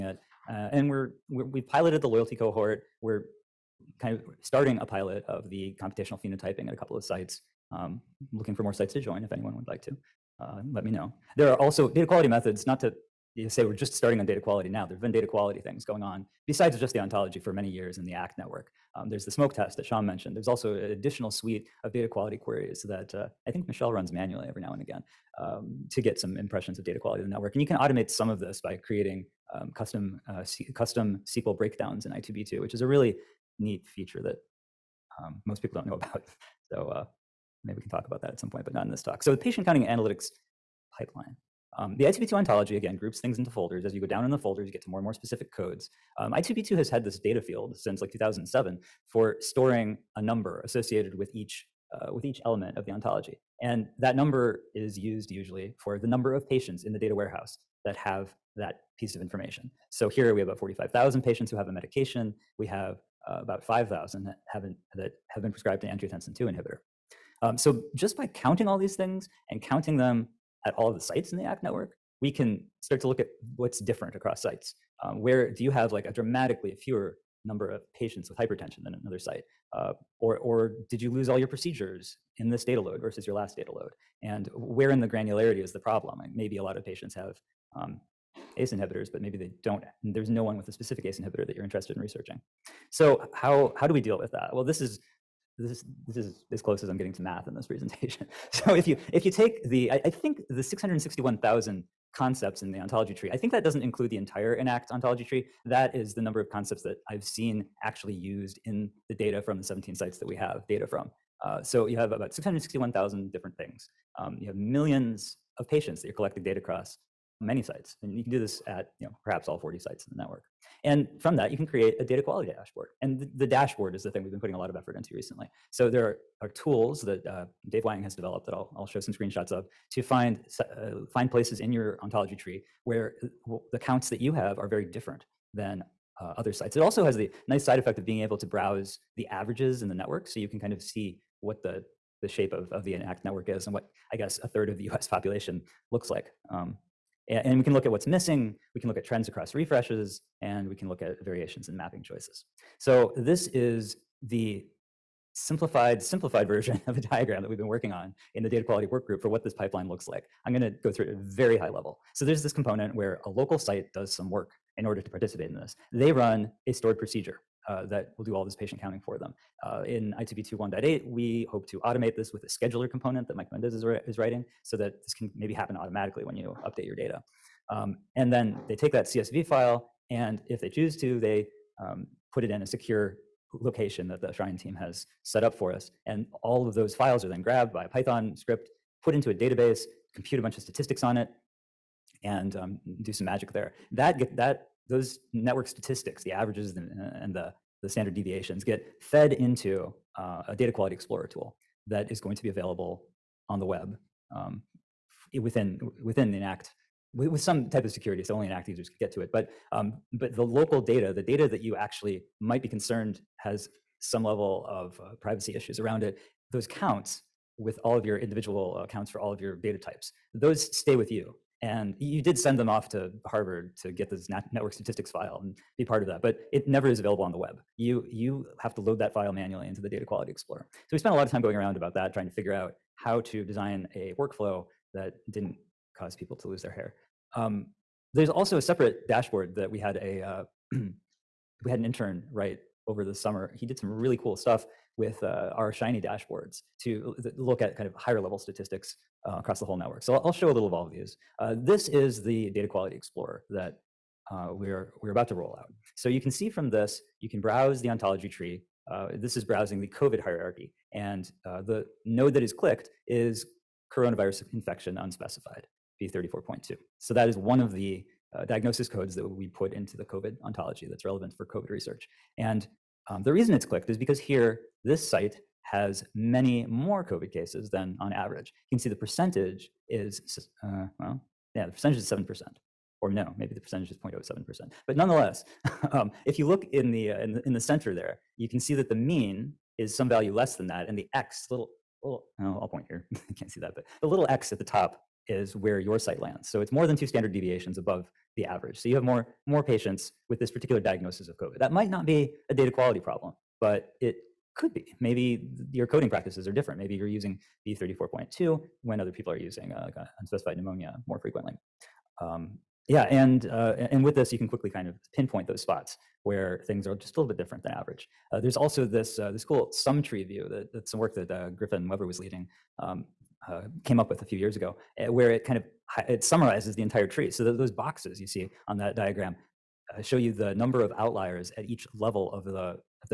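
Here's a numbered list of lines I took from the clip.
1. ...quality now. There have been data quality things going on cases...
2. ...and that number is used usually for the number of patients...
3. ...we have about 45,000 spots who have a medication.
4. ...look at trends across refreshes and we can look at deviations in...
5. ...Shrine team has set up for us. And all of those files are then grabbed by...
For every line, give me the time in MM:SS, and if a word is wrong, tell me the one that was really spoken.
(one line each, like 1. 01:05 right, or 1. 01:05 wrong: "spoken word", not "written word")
1. 00:14 wrong: "besides", not "cases"
2. 00:53 right
3. 01:00 wrong: "patients", not "spots"
4. 02:28 wrong: "variations", not "deviations"
5. 03:04 right.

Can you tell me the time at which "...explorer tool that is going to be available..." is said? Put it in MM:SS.
03:20.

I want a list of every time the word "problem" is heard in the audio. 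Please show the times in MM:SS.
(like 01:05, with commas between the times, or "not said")
01:25, 05:02.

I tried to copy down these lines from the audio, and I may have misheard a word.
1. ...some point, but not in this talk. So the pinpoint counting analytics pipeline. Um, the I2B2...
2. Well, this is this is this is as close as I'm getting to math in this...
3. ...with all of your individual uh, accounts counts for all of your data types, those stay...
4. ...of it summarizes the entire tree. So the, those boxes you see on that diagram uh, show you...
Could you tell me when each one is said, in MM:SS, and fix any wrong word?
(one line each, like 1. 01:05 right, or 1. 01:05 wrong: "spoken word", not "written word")
1. 00:38 wrong: "patient", not "pinpoint"
2. 01:34 right
3. 03:37 right
4. 05:25 right.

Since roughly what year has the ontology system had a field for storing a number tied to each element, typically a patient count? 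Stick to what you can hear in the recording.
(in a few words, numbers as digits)
2007.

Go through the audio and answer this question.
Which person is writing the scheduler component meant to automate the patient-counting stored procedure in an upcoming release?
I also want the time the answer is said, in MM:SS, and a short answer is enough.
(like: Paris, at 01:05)
Mike Mendez, at 02:53.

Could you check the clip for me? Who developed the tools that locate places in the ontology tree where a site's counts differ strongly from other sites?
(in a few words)
Dave Wang.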